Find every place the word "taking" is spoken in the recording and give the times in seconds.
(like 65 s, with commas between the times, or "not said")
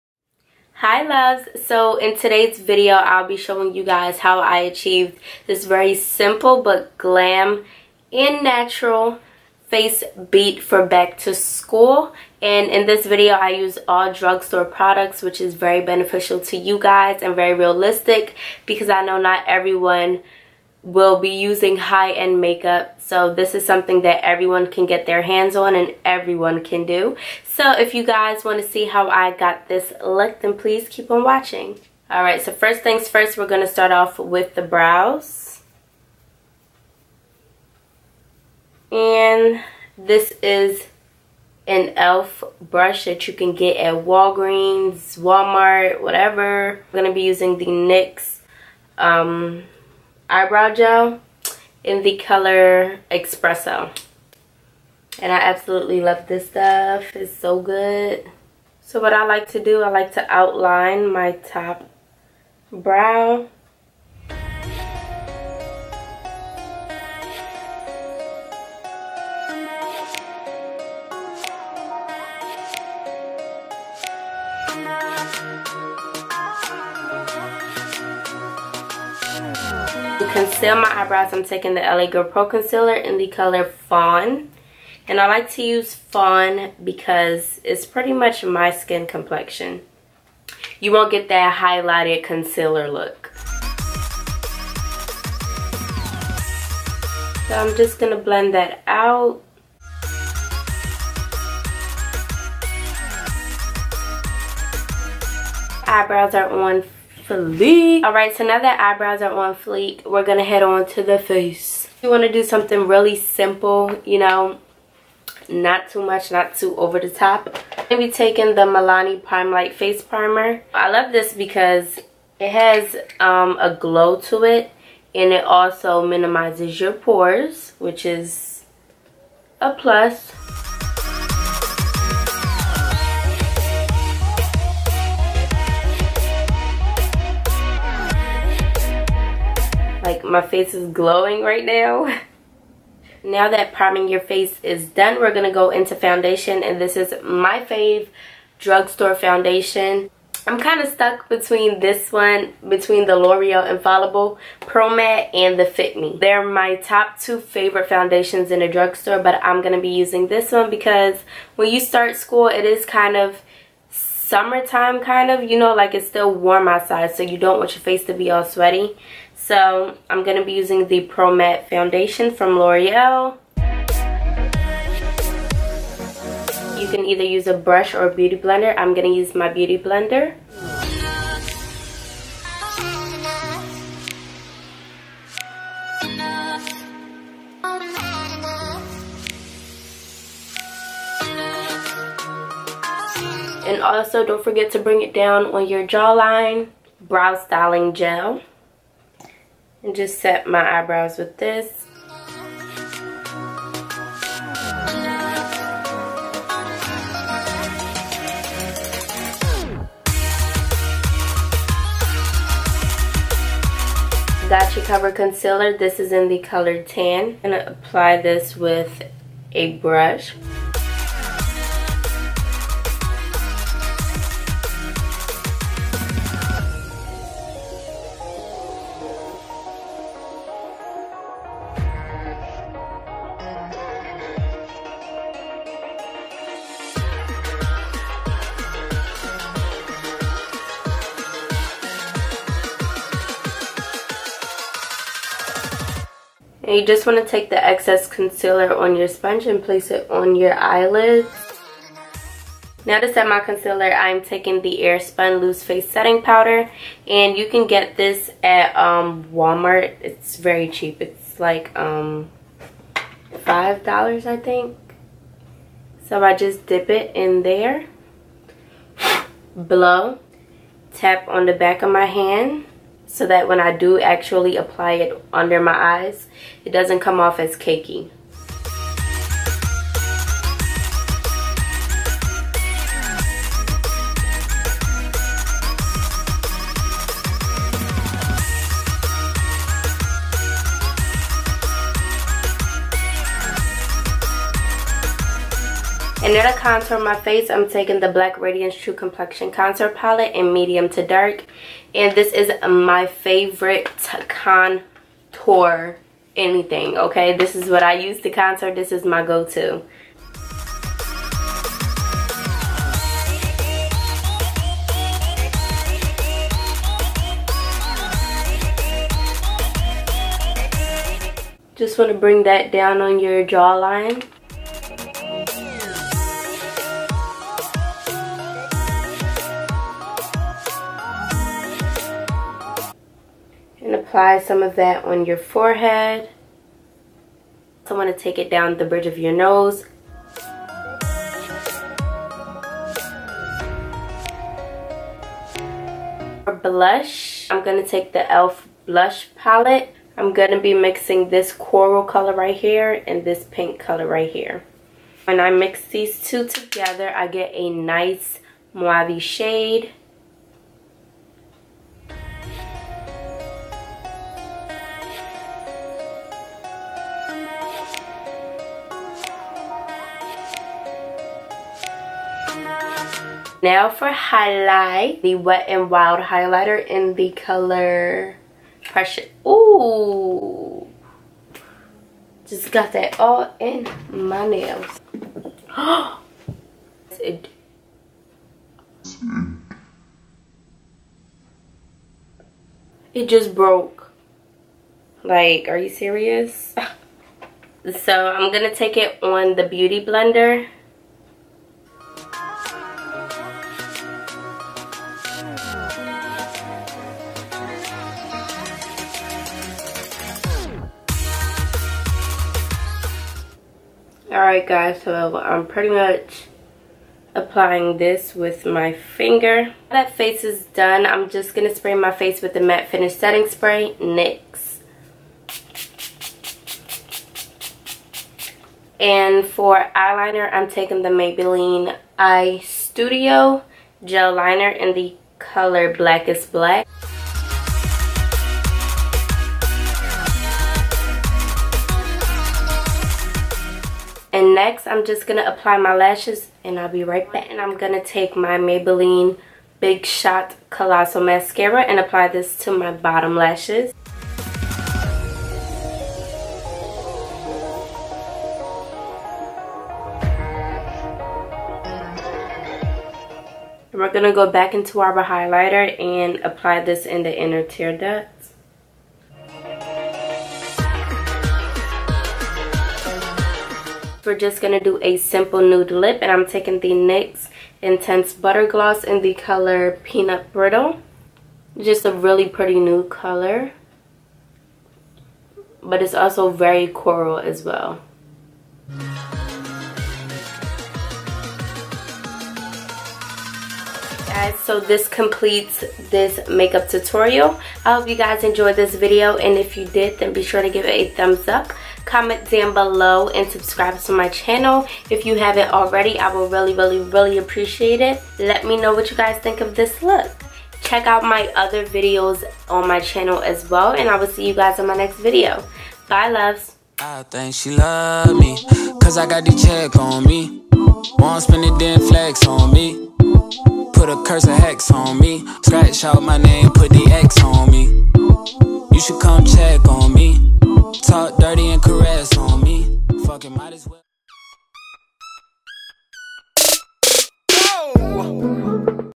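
81 s, 118 s, 254 s, 297 s, 430 s, 476 s.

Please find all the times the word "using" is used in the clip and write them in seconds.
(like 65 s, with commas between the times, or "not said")
21 s, 47 s, 159 s, 170 s.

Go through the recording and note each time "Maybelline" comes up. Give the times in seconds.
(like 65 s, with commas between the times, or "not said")
431 s, 448 s.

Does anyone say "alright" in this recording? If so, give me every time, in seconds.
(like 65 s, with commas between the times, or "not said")
32 s, 108 s, 414 s.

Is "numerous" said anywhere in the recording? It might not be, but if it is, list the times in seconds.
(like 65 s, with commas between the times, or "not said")
not said.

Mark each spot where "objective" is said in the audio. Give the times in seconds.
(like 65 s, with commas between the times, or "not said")
not said.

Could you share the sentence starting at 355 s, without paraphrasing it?
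When I mix these two together, I get a nice mauve shade.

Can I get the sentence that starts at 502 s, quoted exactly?
Comment down below and subscribe to my channel.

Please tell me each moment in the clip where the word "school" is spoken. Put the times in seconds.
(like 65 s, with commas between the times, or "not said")
11 s, 162 s.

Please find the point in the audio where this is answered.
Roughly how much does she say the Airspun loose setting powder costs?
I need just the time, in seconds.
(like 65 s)
263 s.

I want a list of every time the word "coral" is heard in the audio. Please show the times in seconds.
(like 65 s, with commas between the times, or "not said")
351 s, 486 s.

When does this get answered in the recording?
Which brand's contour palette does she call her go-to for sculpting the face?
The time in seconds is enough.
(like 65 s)
298 s.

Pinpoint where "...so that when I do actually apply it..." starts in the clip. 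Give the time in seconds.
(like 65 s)
273 s.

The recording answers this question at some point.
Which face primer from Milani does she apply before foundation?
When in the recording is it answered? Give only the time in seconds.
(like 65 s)
119 s.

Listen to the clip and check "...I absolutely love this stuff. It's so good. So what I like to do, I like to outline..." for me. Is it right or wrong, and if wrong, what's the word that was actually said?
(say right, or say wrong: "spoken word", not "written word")
right.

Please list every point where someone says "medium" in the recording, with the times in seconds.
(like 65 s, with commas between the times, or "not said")
300 s.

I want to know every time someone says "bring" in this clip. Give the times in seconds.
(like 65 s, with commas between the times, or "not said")
194 s, 322 s.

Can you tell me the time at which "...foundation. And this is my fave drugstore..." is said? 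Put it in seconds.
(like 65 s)
145 s.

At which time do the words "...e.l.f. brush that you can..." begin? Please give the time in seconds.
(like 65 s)
41 s.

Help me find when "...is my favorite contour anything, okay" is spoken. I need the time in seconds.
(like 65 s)
302 s.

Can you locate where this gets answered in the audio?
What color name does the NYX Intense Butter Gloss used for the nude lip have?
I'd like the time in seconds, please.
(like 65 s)
480 s.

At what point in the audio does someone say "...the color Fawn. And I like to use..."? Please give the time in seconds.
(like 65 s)
83 s.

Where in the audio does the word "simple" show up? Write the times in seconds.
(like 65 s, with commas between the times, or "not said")
5 s, 113 s, 475 s.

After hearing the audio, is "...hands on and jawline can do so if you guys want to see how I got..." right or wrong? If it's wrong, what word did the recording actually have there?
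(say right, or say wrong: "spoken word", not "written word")
wrong: "everyone", not "jawline".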